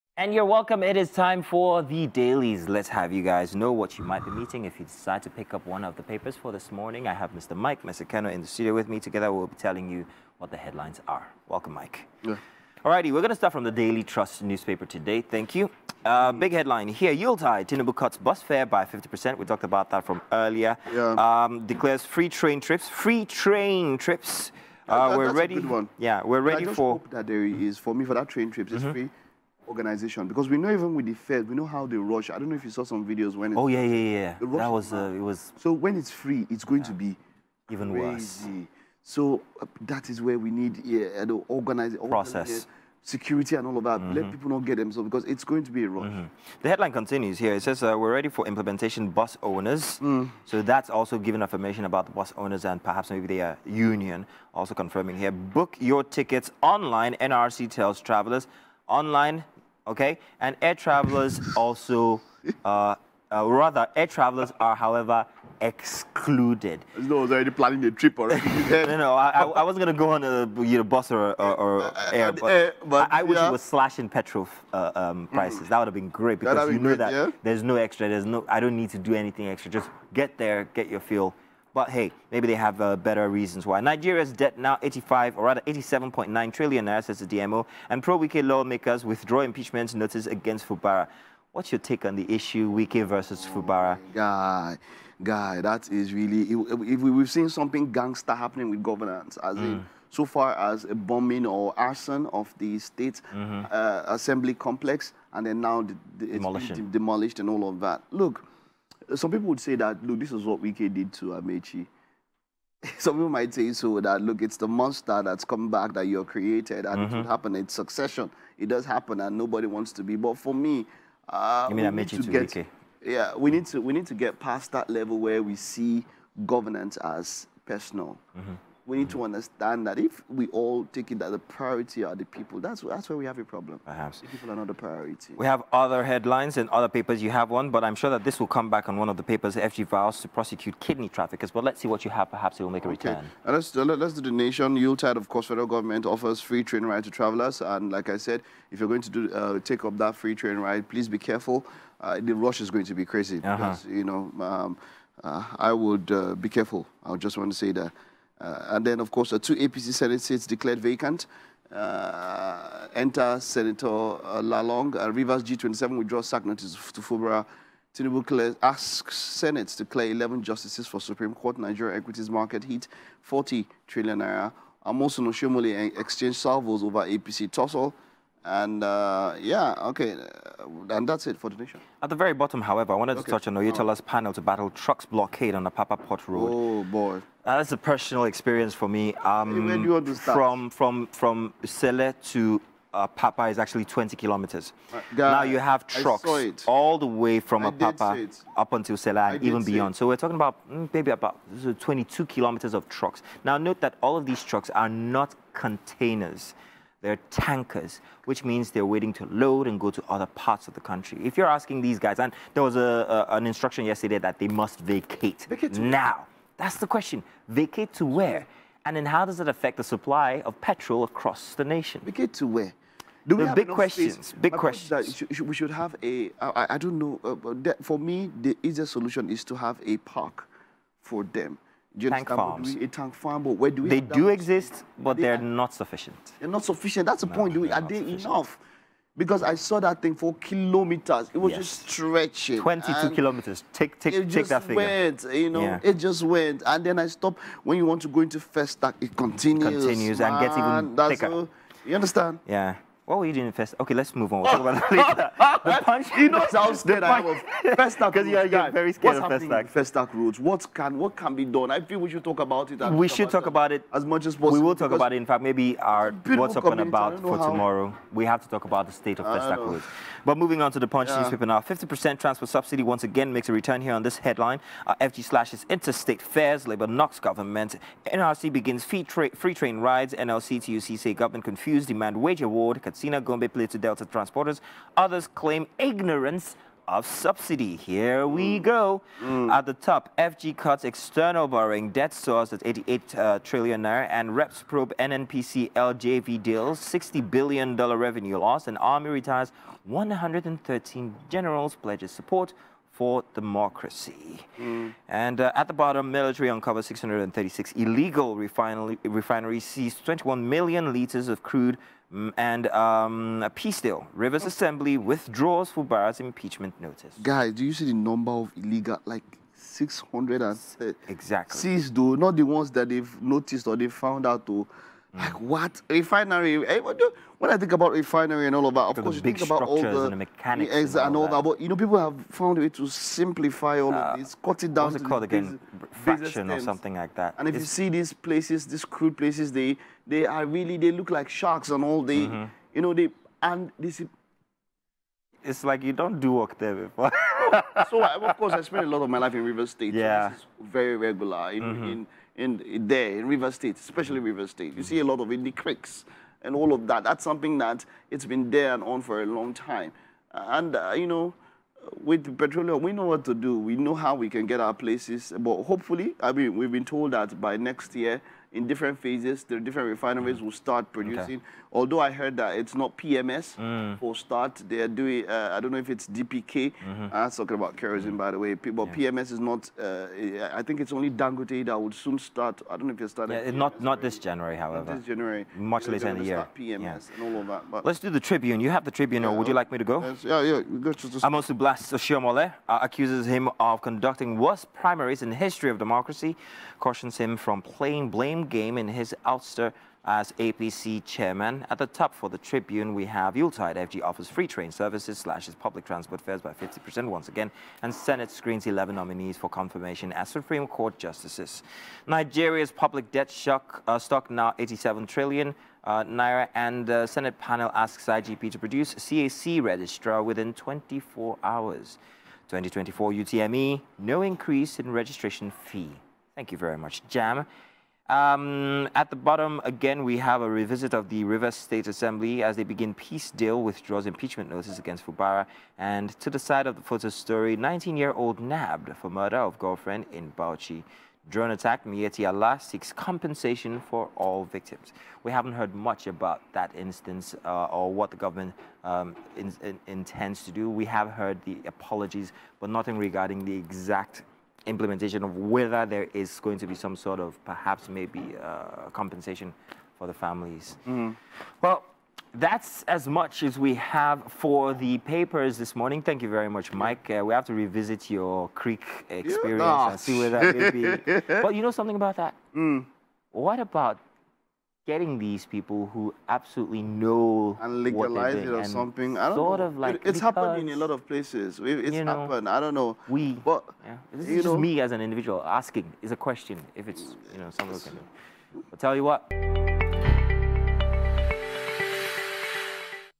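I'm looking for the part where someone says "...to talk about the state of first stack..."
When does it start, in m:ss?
4:28.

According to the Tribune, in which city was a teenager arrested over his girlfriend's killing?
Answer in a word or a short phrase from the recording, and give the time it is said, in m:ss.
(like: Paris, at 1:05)
Bauchi, at 7:20.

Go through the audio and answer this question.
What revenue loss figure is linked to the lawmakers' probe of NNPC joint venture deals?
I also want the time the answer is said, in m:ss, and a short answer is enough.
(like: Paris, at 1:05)
60 billion dollars, at 4:56.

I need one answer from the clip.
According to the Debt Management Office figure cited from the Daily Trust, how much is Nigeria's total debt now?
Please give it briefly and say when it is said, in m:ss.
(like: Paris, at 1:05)
87.9 trillion naira, at 1:25.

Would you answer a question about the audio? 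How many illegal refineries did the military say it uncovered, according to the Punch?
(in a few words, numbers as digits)
636.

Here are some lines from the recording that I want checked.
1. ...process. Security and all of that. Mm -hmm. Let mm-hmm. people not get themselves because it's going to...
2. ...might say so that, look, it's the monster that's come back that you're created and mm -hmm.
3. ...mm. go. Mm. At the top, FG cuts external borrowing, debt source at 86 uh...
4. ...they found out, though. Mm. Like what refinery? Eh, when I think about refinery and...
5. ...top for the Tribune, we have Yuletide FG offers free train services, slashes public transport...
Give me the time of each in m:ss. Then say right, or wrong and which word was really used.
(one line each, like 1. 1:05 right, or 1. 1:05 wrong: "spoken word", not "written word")
1. 0:42 right
2. 1:53 right
3. 4:48 wrong: "88", not "86"
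4. 5:23 right
5. 6:41 right.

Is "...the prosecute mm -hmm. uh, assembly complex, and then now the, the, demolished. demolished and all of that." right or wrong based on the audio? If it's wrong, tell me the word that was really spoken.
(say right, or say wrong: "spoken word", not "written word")
wrong: "state", not "prosecute".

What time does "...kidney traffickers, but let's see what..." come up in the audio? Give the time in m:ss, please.
2:20.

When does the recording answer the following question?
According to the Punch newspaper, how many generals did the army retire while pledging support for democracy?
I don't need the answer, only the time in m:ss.
4:59.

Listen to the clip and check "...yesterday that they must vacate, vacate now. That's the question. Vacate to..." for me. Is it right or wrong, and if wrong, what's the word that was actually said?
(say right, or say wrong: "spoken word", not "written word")
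right.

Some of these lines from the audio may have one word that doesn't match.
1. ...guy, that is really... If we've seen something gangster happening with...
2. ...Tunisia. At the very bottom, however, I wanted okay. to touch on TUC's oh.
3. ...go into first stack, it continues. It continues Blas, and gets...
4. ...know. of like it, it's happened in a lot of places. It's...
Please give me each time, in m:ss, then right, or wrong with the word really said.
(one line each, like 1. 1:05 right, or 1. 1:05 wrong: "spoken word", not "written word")
1. 1:35 right
2. 3:01 wrong: "Oyetola", not "TUC"
3. 4:08 wrong: "Man", not "Blas"
4. 7:59 right.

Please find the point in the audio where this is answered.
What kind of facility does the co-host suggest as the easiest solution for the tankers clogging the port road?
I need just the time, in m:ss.
3:51.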